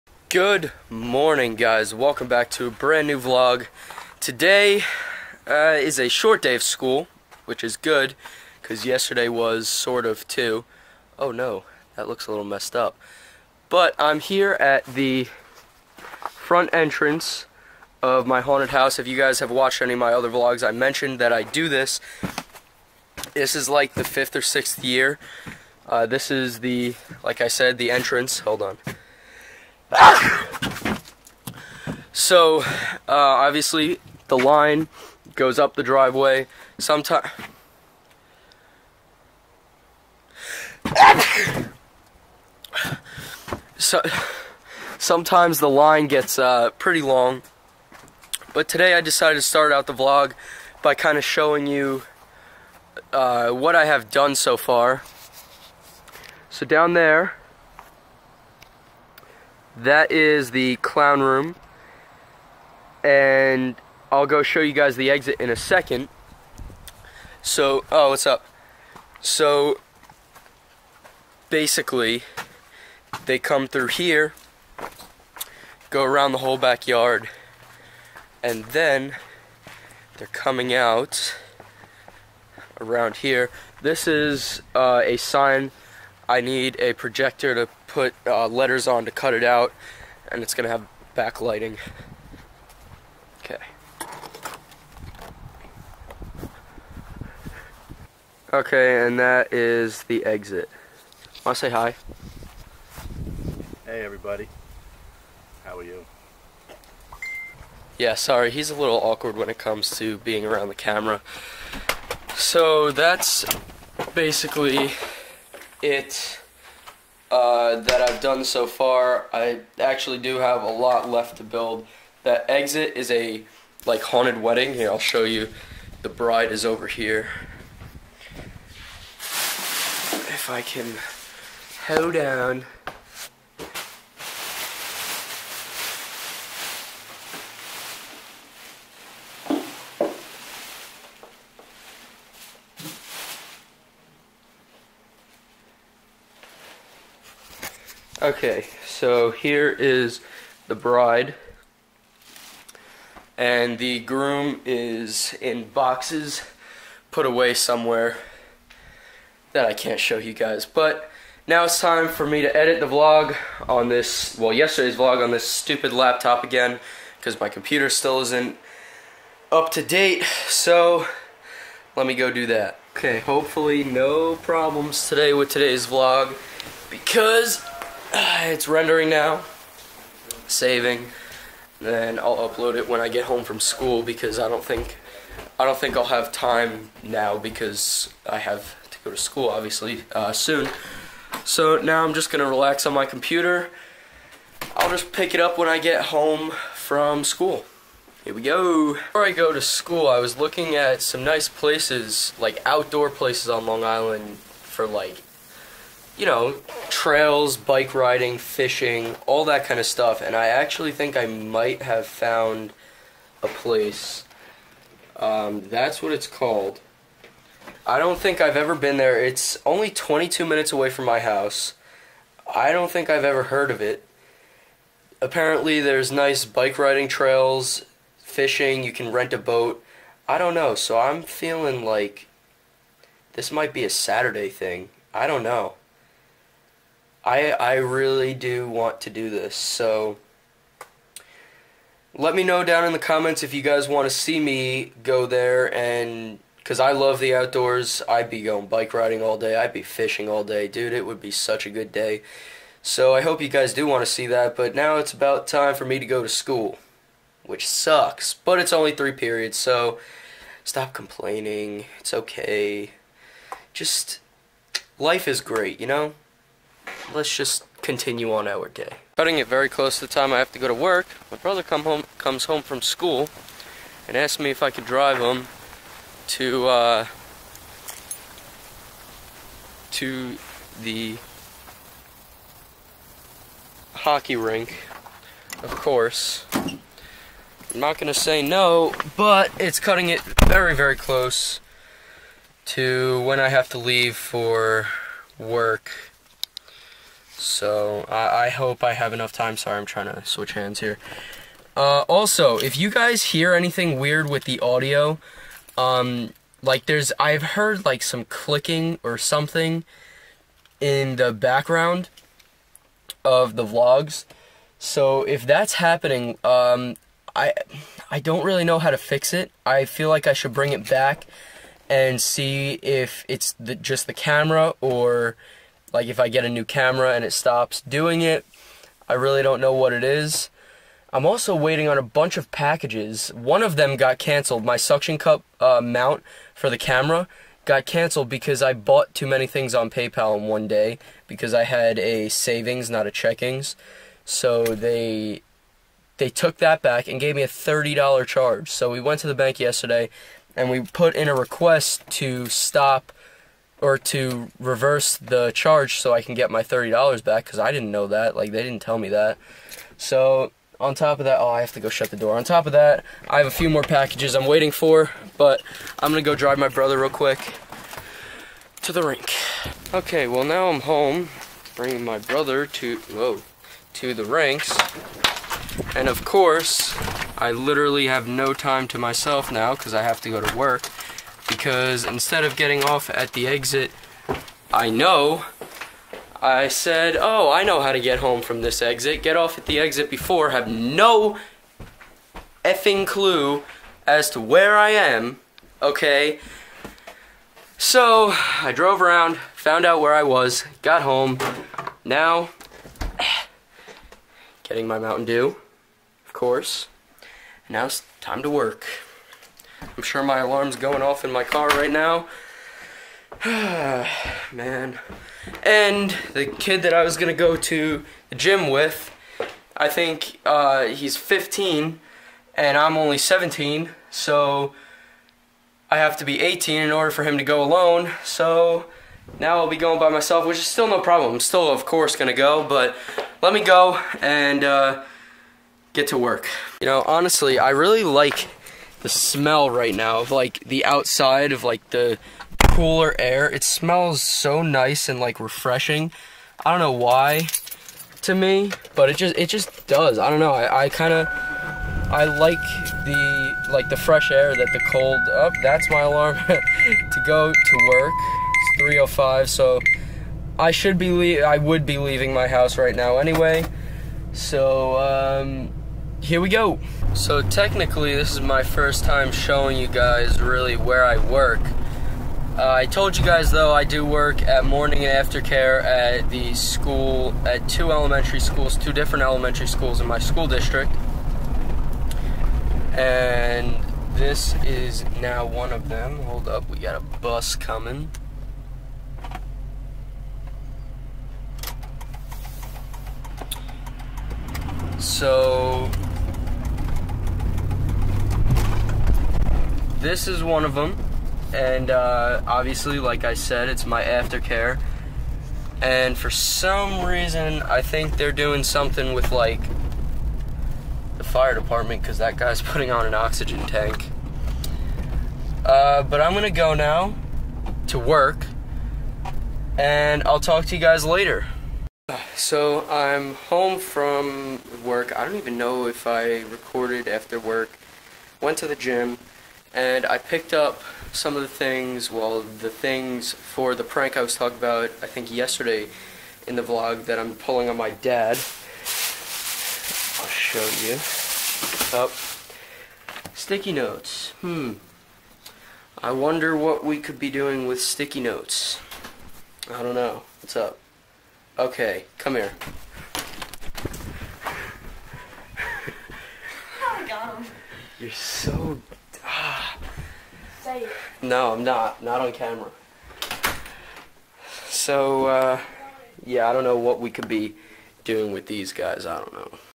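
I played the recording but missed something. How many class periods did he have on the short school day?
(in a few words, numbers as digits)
3.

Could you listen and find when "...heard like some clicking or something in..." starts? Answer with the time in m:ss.
5:07.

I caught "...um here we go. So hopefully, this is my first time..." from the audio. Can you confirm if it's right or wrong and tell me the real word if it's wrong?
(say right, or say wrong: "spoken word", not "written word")
wrong: "technically", not "hopefully".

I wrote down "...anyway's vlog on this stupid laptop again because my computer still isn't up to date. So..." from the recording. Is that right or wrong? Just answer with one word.
wrong.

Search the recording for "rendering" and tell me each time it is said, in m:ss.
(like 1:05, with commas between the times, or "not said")
2:58.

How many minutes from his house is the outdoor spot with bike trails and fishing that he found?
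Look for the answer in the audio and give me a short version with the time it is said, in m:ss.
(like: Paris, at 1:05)
22, at 3:39.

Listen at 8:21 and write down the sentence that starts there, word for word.
And uh, obviously, like I said, it's my aftercare.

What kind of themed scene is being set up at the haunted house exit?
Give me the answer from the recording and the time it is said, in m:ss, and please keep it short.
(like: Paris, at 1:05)
haunted wedding, at 2:04.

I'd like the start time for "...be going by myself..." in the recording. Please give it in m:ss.
7:09.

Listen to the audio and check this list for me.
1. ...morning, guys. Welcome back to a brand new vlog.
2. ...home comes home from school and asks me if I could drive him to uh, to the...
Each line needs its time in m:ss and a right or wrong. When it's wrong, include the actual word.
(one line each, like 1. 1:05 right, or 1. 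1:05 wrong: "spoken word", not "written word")
1. 0:00 right
2. 4:31 right.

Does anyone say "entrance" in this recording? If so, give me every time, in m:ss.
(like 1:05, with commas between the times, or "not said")
0:16, 0:27.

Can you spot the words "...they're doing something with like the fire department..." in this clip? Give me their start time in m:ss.
8:28.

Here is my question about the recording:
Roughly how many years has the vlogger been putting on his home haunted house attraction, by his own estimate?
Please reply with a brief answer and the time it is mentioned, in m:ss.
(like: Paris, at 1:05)
5 or 6, at 0:24.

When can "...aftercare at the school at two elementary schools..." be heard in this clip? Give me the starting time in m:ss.
7:55.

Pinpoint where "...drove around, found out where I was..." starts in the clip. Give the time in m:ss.
6:38.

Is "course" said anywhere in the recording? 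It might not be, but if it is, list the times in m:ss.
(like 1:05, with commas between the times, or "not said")
4:45, 6:16, 6:46, 7:11.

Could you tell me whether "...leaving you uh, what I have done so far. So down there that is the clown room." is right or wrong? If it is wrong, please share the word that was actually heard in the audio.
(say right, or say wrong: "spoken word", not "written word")
wrong: "showing", not "leaving".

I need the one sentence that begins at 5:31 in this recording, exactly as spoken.
I'm also waiting on a bunch of packages.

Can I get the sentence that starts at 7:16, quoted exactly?
You know, honestly, I really like the smell right now of like the outside of like the cooler air.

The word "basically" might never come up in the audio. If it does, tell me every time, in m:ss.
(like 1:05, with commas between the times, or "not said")
1:11, 1:54.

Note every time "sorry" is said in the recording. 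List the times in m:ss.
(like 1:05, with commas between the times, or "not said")
1:48, 4:59.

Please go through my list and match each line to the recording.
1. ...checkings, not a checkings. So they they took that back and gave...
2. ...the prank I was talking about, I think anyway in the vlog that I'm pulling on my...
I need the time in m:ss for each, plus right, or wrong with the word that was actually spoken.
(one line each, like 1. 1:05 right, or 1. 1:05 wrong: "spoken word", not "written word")
1. 5:42 wrong: "savings", not "checkings"
2. 8:53 wrong: "yesterday", not "anyway".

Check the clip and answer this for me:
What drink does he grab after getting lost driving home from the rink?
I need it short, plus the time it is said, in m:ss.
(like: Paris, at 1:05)
Mountain Dew, at 6:44.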